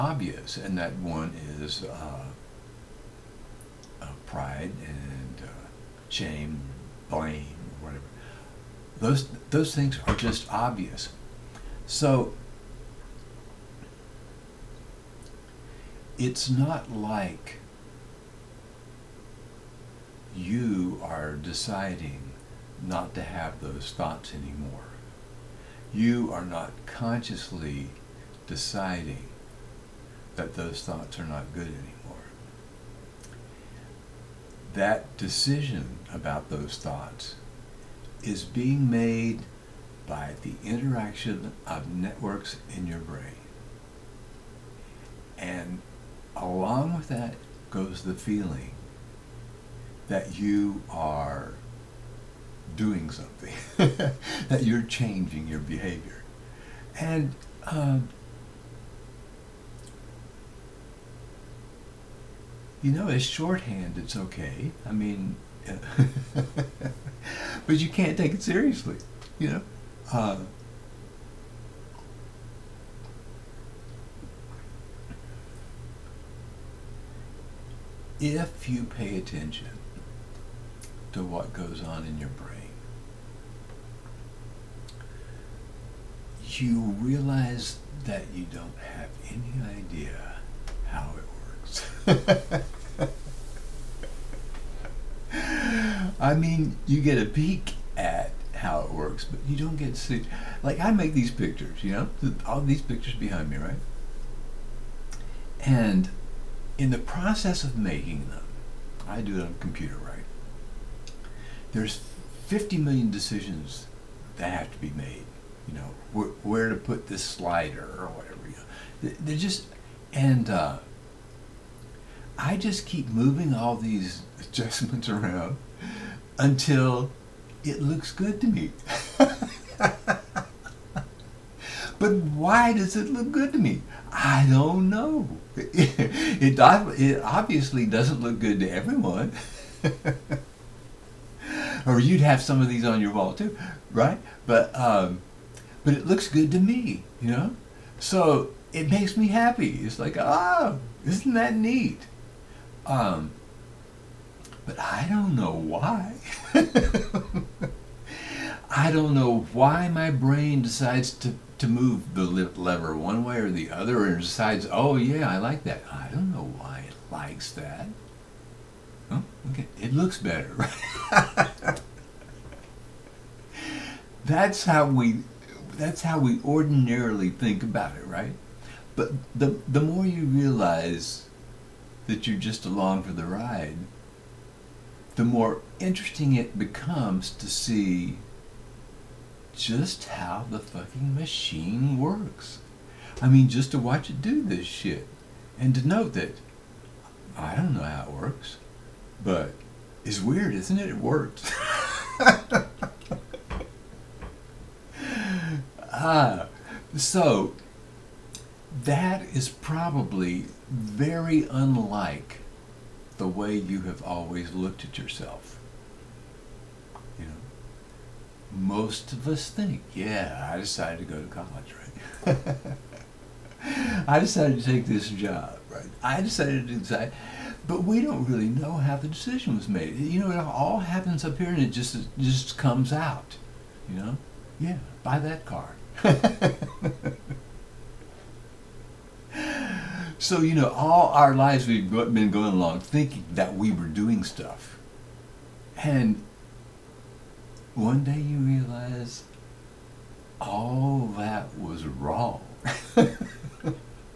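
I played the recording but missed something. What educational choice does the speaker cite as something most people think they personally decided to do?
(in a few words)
go to college.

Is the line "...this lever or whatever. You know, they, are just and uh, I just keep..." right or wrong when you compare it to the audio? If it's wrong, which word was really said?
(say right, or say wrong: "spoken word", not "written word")
wrong: "slider", not "lever".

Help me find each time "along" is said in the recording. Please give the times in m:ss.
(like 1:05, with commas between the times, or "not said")
0:46, 3:02, 4:02.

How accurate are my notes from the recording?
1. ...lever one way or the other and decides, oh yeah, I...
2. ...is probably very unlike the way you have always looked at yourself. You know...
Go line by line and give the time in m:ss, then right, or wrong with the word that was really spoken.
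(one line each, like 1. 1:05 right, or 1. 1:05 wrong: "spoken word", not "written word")
1. 2:42 right
2. 3:29 right.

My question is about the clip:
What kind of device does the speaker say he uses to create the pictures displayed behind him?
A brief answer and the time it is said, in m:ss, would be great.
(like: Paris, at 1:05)
computer, at 1:49.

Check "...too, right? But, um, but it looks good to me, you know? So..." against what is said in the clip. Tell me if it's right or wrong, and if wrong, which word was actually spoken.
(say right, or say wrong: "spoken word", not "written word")
right.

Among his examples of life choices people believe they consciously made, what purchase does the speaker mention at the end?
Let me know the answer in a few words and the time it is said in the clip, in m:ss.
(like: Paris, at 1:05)
car, at 3:55.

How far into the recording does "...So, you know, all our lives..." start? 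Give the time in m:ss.
4:00.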